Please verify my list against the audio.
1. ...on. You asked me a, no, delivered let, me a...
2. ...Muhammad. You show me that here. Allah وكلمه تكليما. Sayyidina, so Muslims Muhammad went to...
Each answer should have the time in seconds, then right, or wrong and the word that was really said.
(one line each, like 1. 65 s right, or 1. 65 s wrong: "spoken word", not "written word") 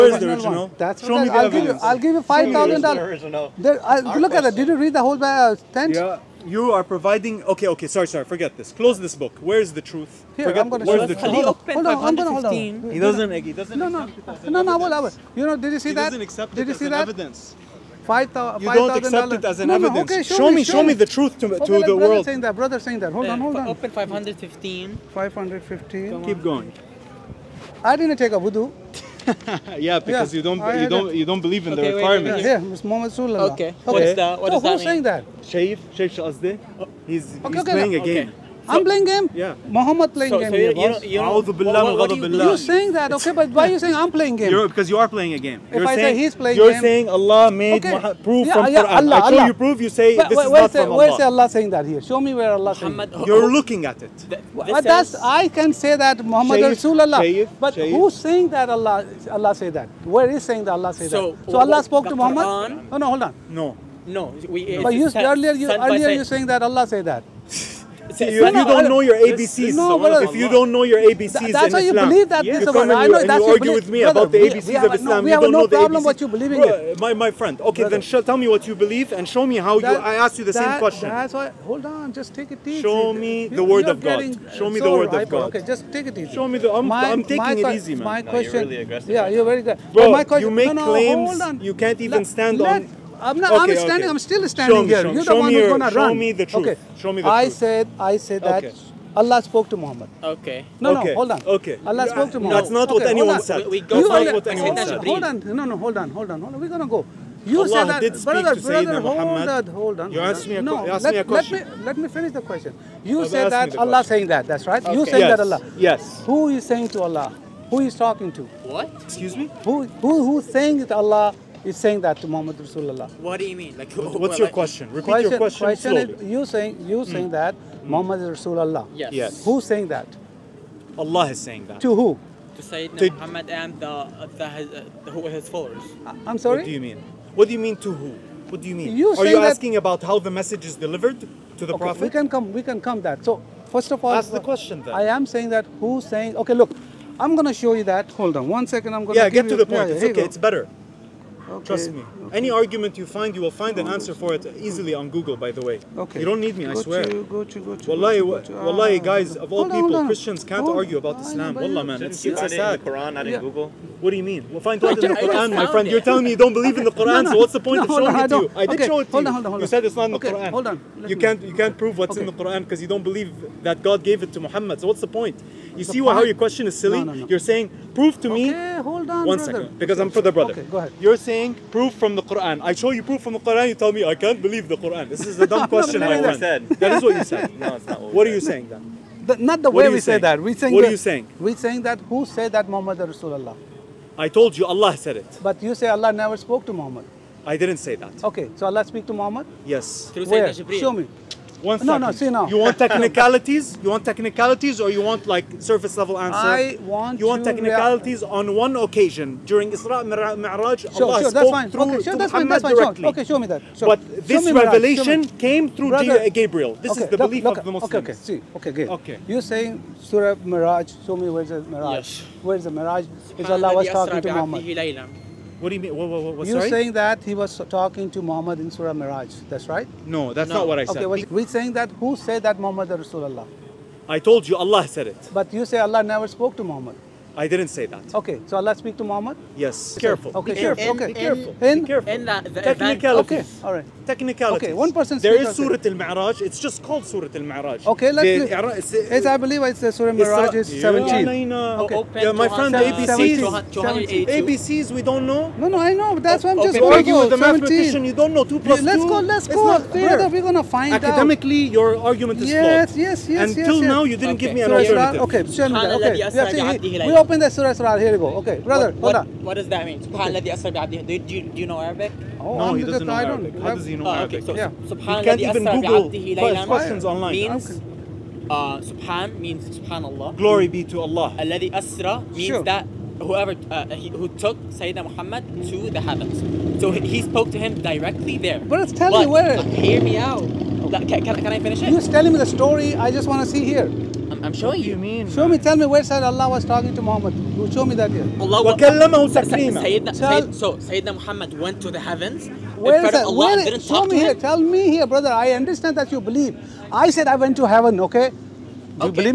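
1. 110 s wrong: "asked", not "delivered"
2. 297 s wrong: "Sayyidina", not "Muslims".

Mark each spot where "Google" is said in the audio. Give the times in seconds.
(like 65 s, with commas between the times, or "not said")
155 s, 163 s, 275 s.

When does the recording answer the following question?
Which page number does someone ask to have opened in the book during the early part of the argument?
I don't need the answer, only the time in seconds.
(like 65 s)
23 s.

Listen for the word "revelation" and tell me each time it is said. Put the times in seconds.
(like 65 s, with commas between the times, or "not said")
214 s.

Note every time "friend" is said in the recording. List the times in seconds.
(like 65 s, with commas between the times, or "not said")
77 s, 165 s, 252 s.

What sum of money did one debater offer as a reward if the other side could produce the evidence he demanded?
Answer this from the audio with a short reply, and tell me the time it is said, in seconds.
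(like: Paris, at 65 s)
$5,000, at 2 s.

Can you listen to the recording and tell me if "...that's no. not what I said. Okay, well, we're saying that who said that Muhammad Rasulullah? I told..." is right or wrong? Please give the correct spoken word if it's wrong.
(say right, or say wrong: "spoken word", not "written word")
right.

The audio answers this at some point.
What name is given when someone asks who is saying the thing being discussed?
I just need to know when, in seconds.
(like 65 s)
35 s.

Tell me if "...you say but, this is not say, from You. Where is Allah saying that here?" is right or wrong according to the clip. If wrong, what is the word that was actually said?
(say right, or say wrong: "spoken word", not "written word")
wrong: "Allah", not "You".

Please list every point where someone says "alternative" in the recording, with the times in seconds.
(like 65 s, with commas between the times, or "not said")
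264 s.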